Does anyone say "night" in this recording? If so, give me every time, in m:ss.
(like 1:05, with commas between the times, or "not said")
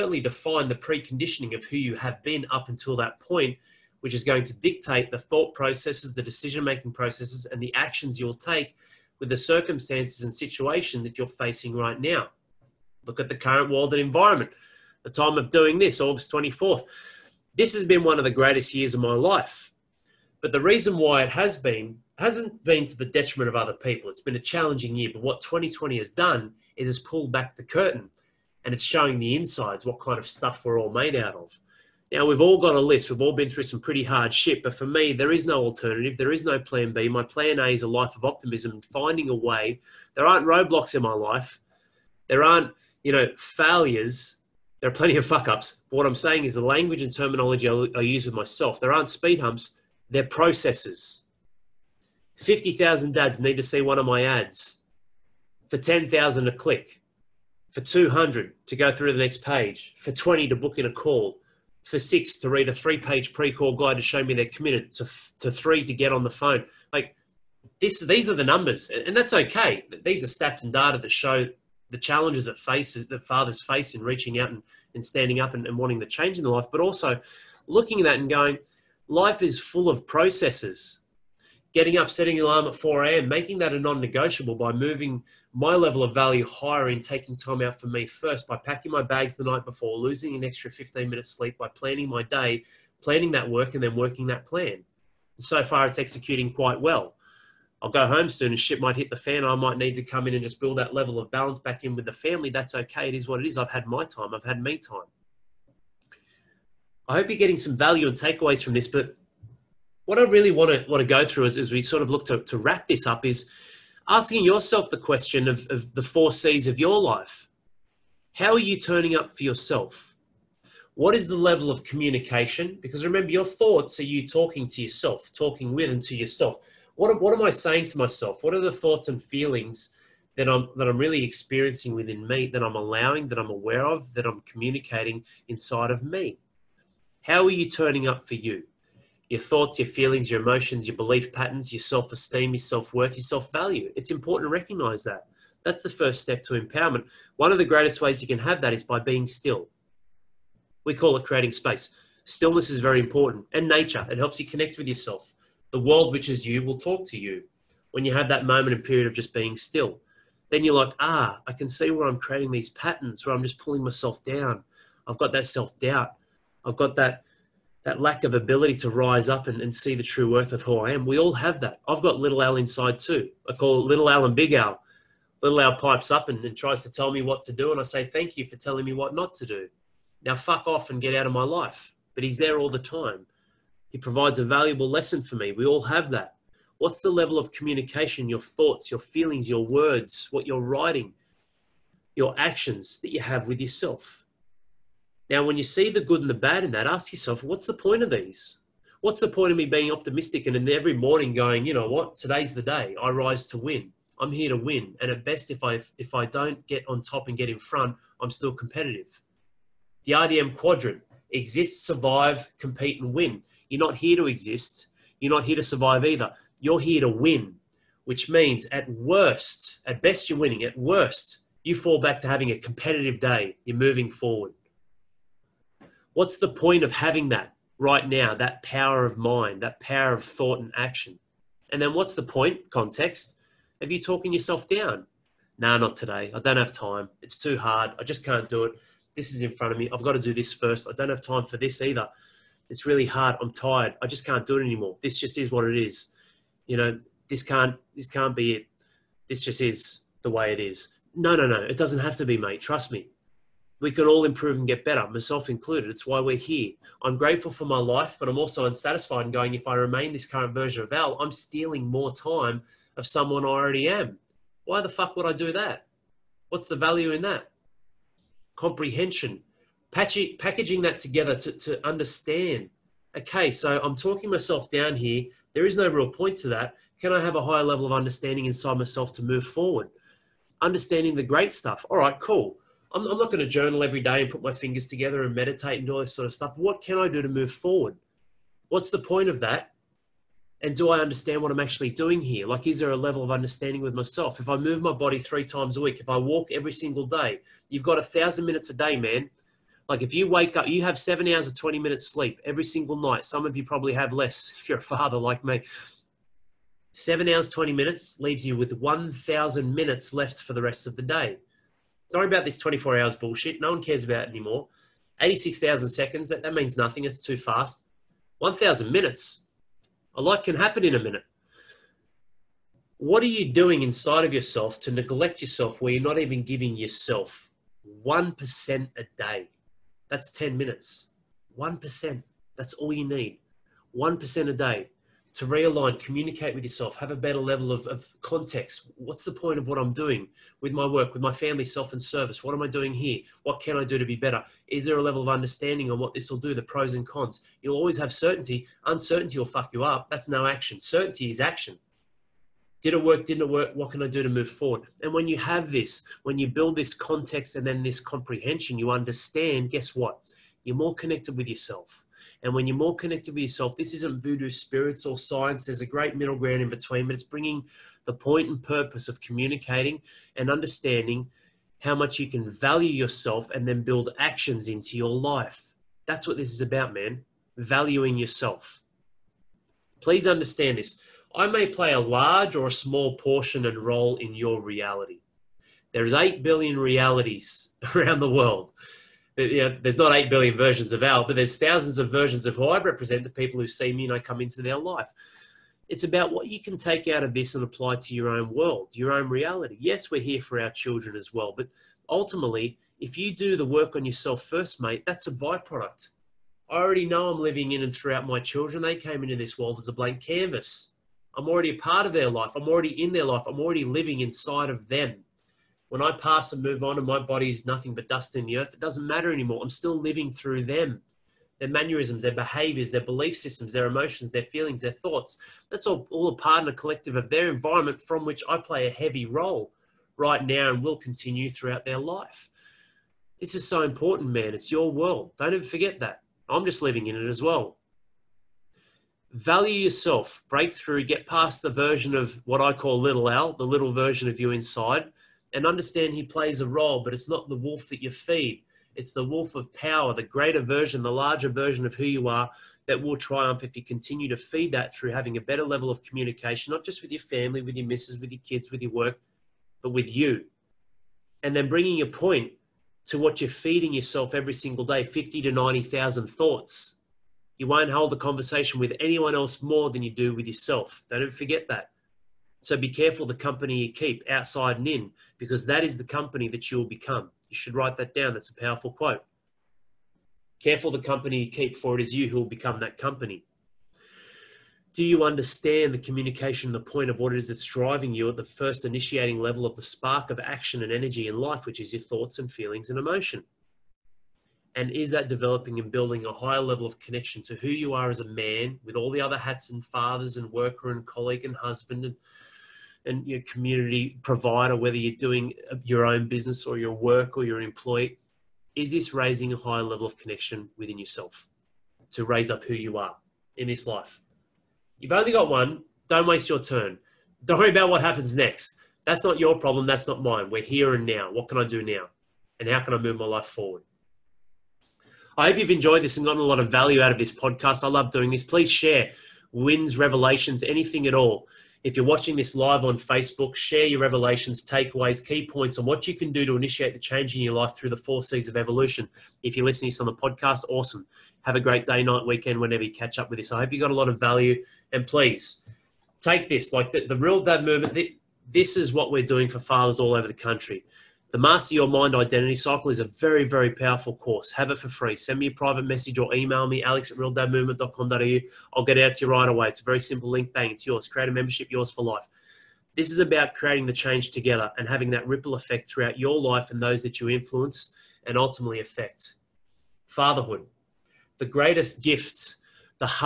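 1:29, 5:02, 9:02.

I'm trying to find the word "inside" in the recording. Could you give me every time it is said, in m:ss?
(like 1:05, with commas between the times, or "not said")
0:29, 2:15, 2:52, 4:38, 5:23, 6:54, 7:24.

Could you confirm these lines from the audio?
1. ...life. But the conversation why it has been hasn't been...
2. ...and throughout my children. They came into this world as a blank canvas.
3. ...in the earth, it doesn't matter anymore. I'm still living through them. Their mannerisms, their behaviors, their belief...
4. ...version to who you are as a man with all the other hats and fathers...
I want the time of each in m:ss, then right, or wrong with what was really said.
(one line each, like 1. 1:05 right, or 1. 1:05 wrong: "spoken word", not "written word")
1. 0:19 wrong: "reason", not "conversation"
2. 6:47 right
3. 6:58 right
4. 8:16 wrong: "connection", not "version".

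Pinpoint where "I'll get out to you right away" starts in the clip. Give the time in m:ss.
9:18.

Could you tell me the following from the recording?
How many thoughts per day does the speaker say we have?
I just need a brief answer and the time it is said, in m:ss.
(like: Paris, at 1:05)
50 to 90,000, at 7:45.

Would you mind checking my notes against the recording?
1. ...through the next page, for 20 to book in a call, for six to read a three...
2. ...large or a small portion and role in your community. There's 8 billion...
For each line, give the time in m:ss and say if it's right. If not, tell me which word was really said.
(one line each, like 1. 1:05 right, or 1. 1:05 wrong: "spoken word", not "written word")
1. 0:58 right
2. 6:21 wrong: "reality", not "community".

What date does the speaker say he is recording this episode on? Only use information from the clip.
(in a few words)
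August 24th.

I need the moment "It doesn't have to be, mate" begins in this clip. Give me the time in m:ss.
4:11.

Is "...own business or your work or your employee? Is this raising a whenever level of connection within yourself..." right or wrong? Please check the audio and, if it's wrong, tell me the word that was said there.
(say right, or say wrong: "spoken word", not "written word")
wrong: "higher", not "whenever".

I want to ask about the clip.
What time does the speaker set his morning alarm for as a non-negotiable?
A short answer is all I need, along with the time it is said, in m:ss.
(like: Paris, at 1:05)
4 a.m., at 1:22.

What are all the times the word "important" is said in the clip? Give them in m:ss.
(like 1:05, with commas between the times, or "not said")
2:24, 2:32, 7:13.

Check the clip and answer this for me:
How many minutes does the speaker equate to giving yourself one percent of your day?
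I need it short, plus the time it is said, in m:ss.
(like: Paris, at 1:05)
10 minutes, at 5:30.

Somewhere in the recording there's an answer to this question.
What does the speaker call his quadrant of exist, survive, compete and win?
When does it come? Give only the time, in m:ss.
3:30.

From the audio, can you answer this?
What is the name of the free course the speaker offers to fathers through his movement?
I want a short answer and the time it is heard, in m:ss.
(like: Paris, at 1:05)
Master Your Mind Identity Cycle, at 9:11.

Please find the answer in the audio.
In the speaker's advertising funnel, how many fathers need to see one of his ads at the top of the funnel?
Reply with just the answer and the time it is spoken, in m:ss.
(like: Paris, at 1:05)
50,000, at 0:52.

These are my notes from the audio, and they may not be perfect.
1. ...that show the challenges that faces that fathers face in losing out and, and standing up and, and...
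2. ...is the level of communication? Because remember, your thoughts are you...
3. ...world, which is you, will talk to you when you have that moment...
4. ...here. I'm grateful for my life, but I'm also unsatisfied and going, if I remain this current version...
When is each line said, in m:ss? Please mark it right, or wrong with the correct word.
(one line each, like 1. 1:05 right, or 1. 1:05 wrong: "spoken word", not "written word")
1. 1:10 wrong: "reaching", not "losing"
2. 2:01 right
3. 2:35 right
4. 4:16 right.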